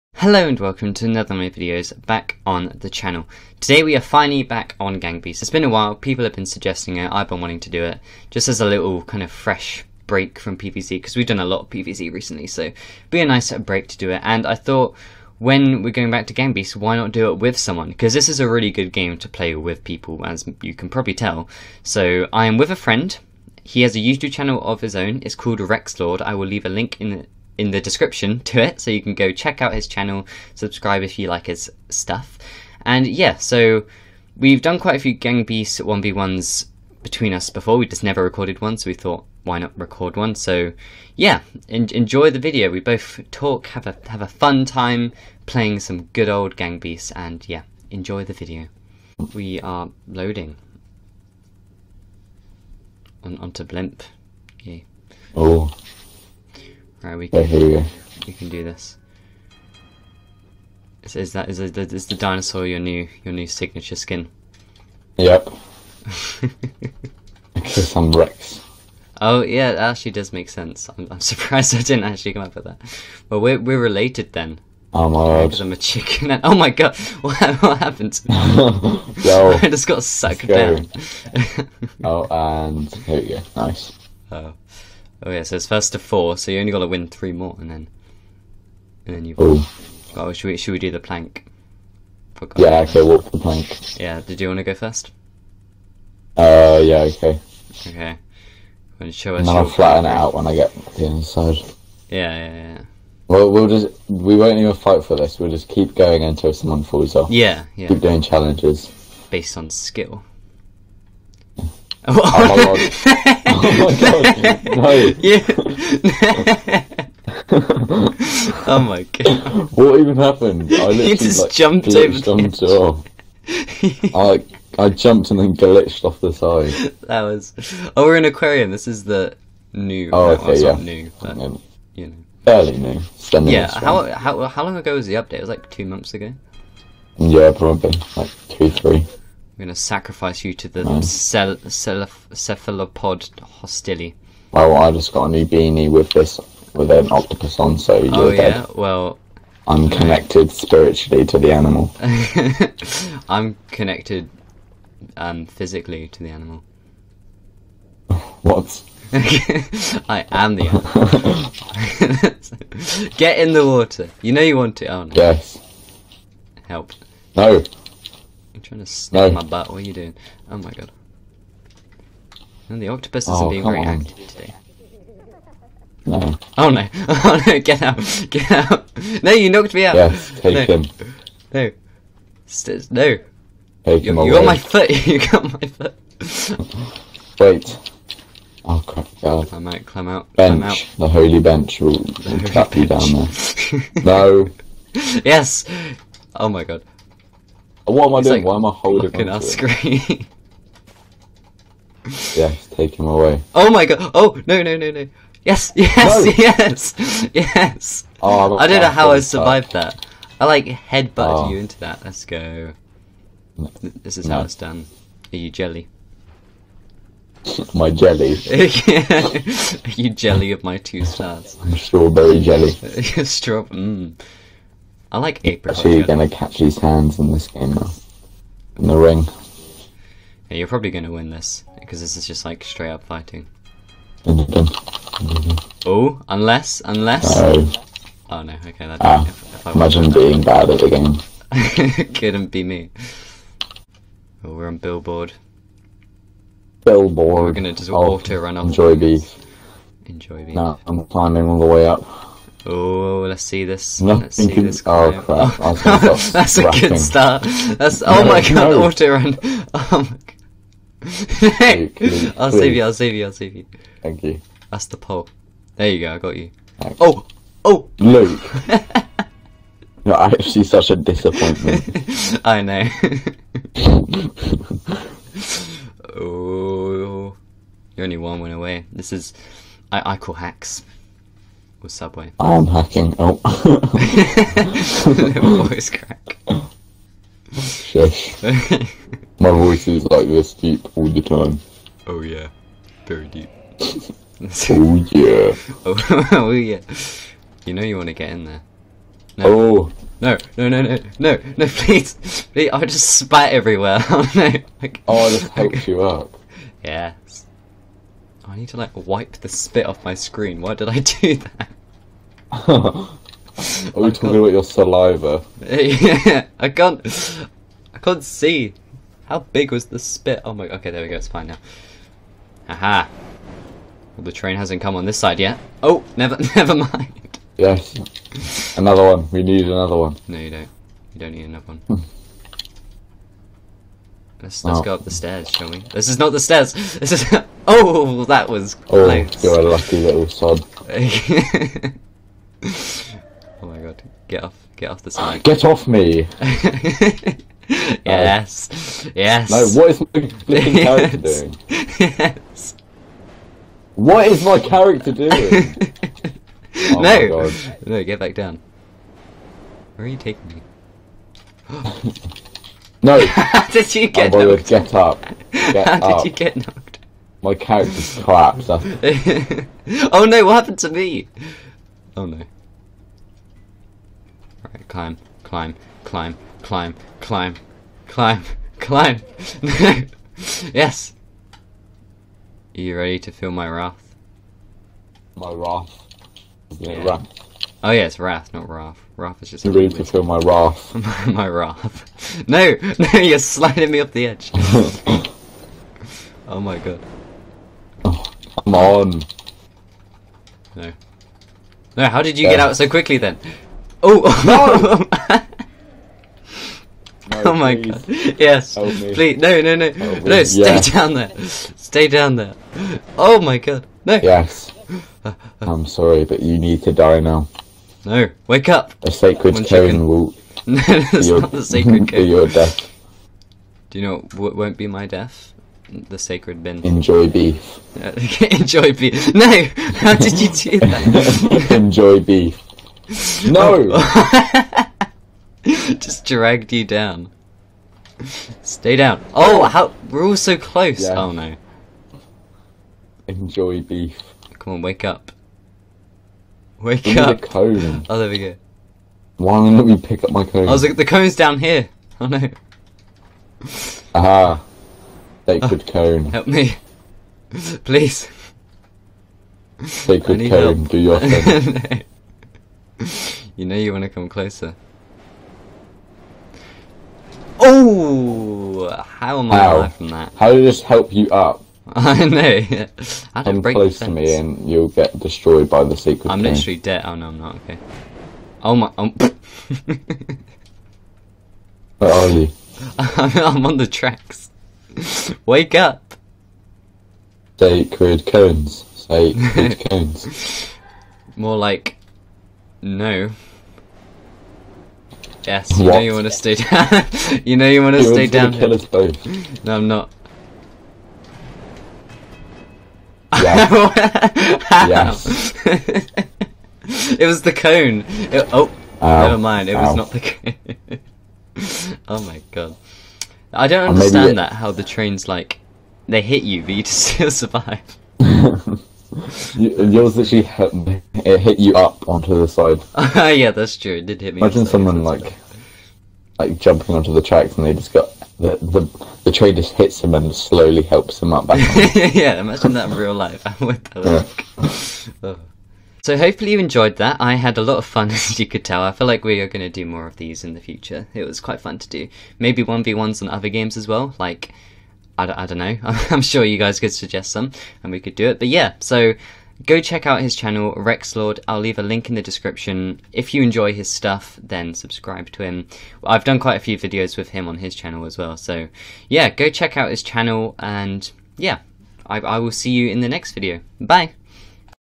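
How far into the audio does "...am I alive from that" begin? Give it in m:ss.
7:49.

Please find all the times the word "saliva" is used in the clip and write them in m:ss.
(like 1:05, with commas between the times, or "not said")
5:14.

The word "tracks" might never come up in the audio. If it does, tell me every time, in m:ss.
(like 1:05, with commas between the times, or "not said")
8:03, 8:47.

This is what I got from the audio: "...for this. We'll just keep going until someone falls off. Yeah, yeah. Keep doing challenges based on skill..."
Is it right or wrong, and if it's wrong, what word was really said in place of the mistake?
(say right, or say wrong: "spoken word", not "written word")
right.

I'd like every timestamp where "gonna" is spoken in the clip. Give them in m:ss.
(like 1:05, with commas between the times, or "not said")
3:46, 3:50, 4:07.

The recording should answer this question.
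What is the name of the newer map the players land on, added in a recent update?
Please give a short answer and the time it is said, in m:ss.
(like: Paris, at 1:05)
aquarium, at 2:08.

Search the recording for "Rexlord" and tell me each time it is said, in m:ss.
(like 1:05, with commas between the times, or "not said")
0:25, 9:10.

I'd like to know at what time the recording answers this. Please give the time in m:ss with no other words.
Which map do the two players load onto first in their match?
0:53.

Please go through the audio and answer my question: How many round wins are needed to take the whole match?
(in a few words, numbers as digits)
4.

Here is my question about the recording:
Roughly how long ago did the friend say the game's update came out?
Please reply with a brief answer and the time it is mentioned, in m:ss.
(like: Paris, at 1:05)
two months, at 2:15.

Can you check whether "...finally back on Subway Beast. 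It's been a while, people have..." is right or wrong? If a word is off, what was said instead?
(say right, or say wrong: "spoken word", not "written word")
wrong: "Gang", not "Subway".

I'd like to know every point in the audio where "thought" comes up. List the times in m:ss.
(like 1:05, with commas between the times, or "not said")
0:14, 0:38.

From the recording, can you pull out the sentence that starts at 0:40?
So yeah, en enjoy the video.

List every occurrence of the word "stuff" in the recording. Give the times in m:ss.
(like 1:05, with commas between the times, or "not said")
0:31, 9:13.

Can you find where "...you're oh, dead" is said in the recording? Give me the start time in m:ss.
2:28.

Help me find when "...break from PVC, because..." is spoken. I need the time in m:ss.
0:10.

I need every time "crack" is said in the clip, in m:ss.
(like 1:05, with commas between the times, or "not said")
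4:45.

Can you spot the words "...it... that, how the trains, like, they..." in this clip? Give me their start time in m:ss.
8:34.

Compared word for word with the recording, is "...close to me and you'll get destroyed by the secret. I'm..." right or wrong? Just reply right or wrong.
right.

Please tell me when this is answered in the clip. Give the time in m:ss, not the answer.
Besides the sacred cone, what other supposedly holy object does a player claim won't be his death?
7:05.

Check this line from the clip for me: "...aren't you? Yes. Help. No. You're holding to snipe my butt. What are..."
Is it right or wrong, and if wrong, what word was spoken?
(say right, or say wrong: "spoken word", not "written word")
wrong: "trying", not "holding".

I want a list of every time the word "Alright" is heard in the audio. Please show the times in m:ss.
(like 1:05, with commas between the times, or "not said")
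0:57.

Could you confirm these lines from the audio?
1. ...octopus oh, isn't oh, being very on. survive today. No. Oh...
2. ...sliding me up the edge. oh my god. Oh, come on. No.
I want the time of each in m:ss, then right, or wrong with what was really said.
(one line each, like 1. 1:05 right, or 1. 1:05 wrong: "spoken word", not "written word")
1. 2:52 wrong: "active", not "survive"
2. 6:33 right.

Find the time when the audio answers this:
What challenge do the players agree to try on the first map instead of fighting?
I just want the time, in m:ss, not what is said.
1:33.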